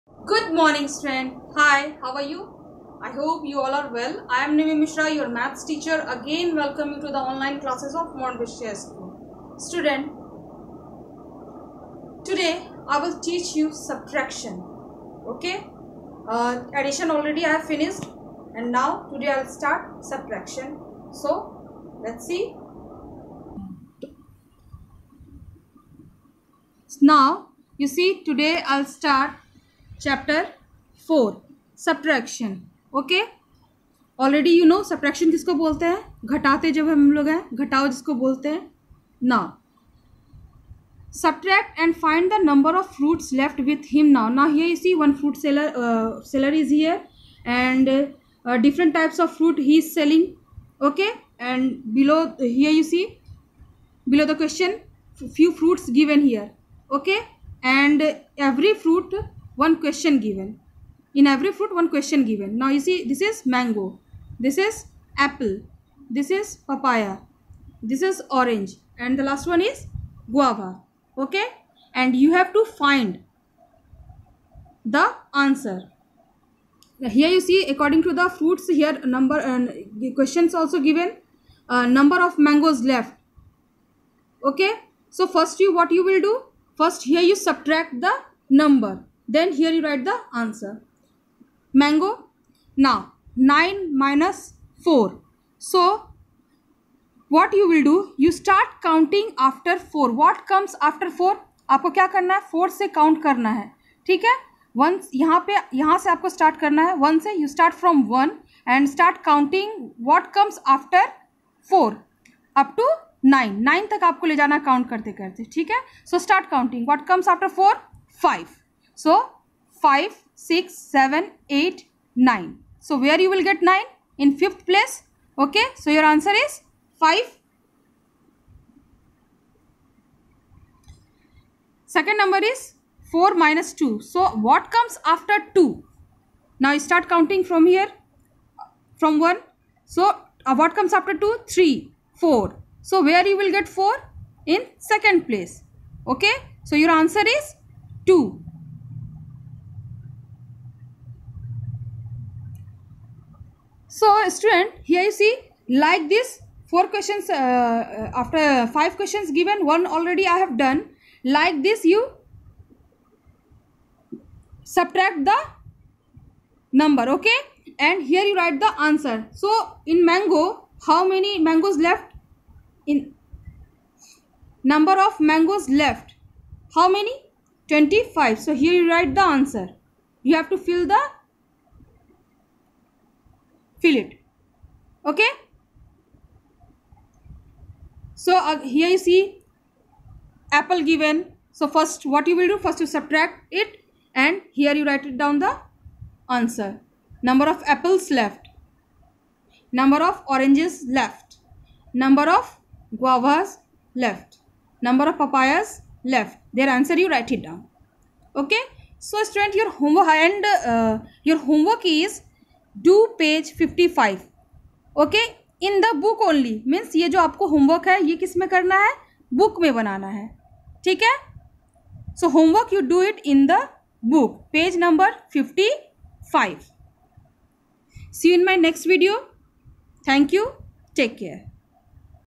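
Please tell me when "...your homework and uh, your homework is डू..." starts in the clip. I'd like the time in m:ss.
3:29.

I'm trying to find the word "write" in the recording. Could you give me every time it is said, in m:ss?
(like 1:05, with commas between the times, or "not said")
1:29, 2:48, 2:58, 3:14, 3:27.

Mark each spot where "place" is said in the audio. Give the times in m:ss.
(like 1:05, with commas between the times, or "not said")
2:04, 2:25.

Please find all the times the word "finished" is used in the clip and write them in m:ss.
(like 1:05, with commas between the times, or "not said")
0:17.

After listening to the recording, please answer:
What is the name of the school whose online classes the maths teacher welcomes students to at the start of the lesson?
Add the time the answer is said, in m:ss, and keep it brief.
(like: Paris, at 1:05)
Montbretia School, at 0:08.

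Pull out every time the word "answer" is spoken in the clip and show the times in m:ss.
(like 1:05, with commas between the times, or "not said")
1:15, 1:30, 2:06, 2:26, 2:48, 2:59, 3:16, 3:26.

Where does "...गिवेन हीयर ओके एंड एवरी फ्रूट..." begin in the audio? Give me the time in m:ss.
0:55.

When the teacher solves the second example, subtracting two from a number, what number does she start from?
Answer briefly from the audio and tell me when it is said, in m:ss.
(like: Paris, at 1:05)
4, at 2:13.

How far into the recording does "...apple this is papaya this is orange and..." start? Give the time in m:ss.
1:05.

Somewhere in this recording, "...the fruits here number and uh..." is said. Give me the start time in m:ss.
1:18.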